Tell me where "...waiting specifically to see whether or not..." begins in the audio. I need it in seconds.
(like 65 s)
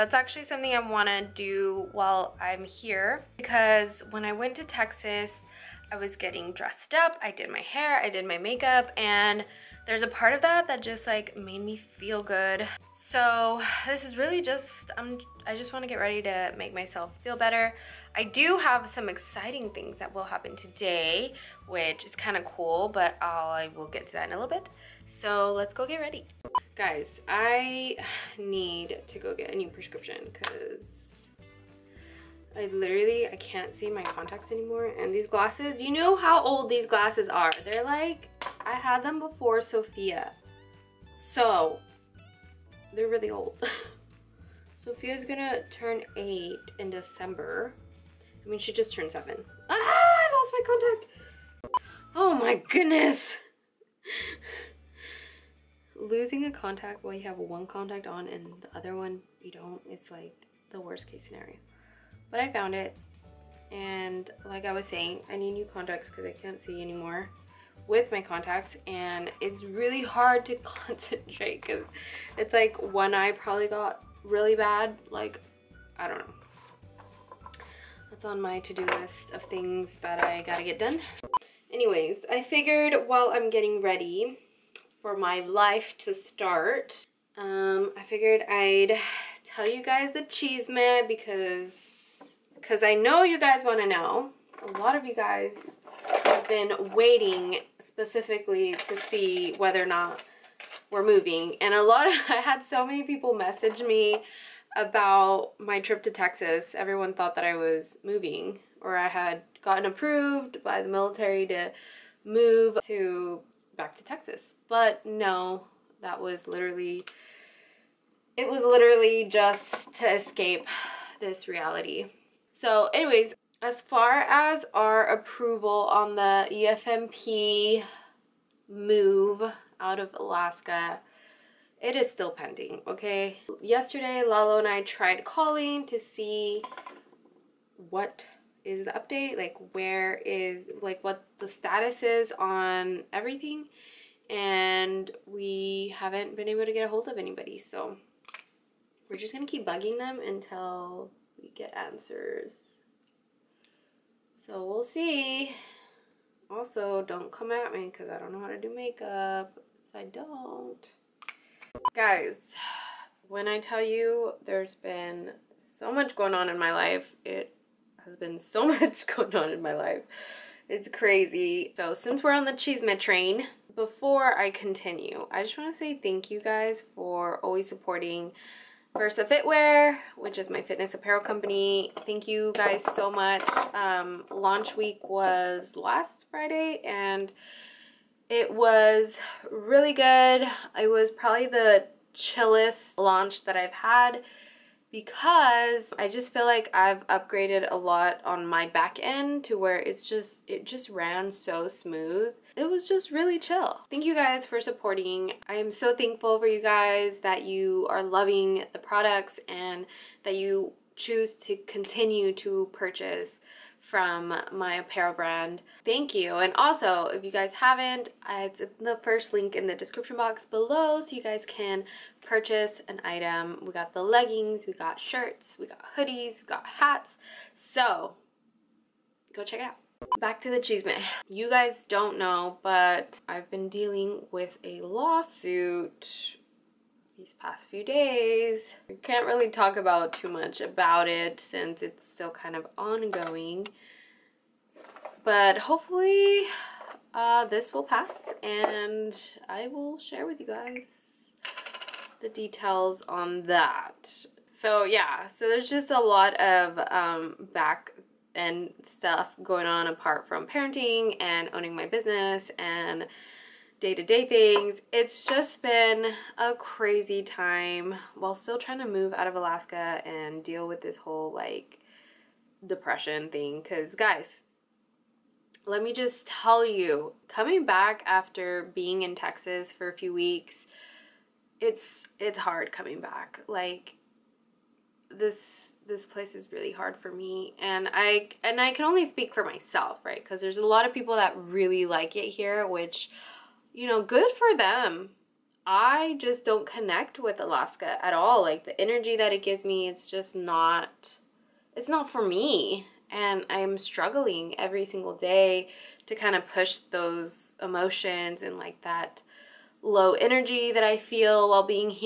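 96 s.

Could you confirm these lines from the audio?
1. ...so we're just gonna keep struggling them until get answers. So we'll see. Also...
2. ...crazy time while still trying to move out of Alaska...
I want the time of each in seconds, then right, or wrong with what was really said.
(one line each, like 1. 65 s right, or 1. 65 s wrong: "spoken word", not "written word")
1. 147 s wrong: "bugging", not "struggling"
2. 266 s right.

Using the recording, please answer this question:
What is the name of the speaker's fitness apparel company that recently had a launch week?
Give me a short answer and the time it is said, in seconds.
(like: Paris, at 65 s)
Versa Fitwear, at 178 s.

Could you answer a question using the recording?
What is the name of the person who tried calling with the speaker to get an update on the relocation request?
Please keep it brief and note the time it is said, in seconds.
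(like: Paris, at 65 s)
Lalo, at 134 s.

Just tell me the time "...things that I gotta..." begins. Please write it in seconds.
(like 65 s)
79 s.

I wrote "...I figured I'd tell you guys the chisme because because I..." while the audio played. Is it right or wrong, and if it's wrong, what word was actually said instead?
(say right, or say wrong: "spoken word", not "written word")
right.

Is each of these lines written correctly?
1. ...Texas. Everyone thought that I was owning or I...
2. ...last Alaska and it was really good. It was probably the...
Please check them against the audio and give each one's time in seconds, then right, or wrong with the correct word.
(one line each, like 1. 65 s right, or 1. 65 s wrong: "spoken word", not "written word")
1. 106 s wrong: "moving", not "owning"
2. 185 s wrong: "Friday", not "Alaska".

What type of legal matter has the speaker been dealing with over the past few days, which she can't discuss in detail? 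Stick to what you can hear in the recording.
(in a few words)
A lawsuit.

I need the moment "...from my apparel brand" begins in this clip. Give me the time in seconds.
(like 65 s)
213 s.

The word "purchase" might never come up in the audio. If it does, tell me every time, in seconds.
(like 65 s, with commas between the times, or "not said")
212 s, 222 s.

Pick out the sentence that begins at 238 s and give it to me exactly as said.
I can't really talk about too much about it since it's still kind of ongoing.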